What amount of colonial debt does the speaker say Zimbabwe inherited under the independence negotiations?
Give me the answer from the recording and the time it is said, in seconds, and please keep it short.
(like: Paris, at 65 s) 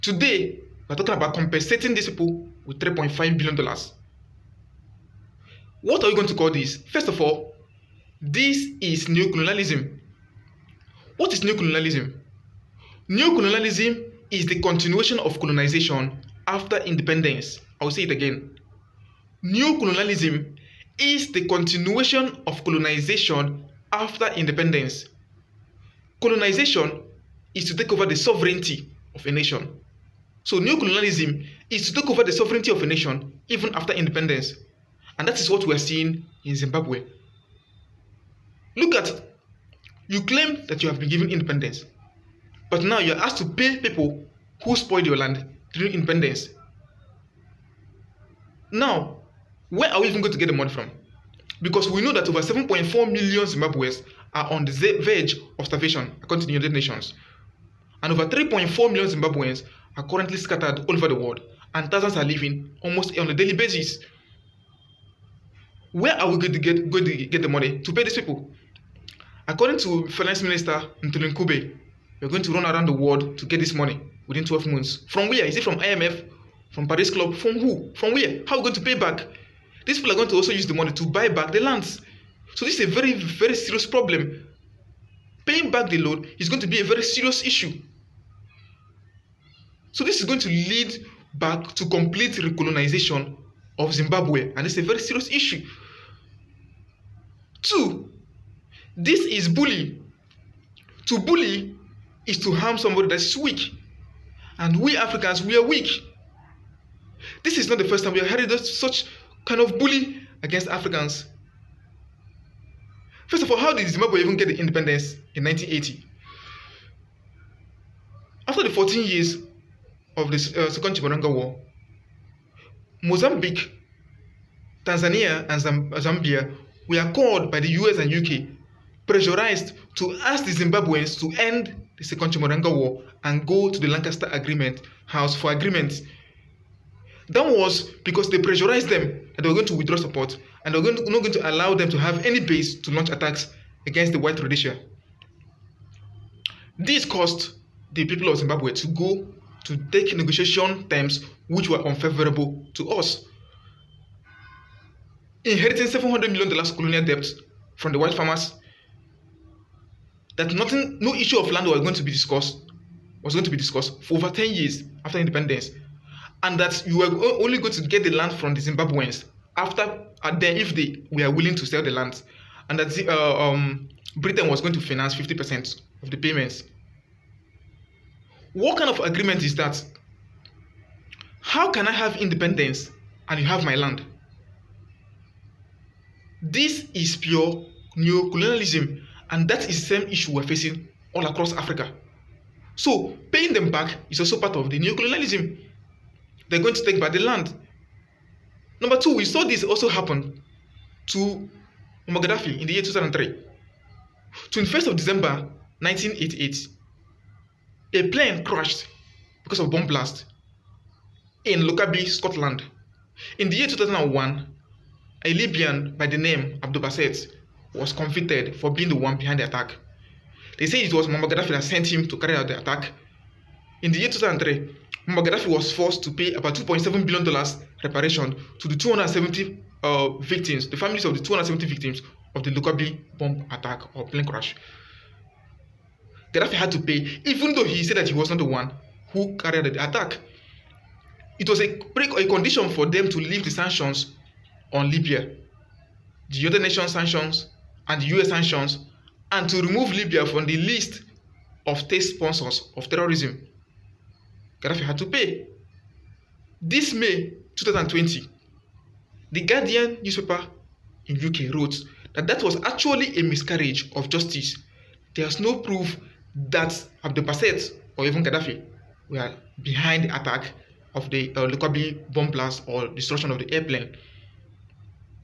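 $700 million, at 155 s.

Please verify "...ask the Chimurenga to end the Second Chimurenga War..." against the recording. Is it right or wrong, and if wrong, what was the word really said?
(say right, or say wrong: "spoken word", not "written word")
wrong: "Zimbabweans", not "Chimurenga".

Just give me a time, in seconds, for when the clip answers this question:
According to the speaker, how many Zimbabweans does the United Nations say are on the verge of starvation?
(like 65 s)
52 s.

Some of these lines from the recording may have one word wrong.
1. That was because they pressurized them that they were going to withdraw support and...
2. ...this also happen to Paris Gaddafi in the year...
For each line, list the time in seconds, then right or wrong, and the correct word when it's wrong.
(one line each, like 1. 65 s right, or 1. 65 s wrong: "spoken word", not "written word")
1. 137 s right
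2. 199 s wrong: "Muammar", not "Paris".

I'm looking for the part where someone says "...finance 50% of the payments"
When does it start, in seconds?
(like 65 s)
174 s.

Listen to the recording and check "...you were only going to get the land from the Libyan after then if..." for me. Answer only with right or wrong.
wrong.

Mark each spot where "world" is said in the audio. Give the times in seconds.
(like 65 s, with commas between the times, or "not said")
61 s, 72 s.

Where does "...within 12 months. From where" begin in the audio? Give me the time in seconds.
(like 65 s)
74 s.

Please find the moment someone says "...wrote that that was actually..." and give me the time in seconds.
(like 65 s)
261 s.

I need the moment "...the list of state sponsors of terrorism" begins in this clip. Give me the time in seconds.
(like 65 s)
250 s.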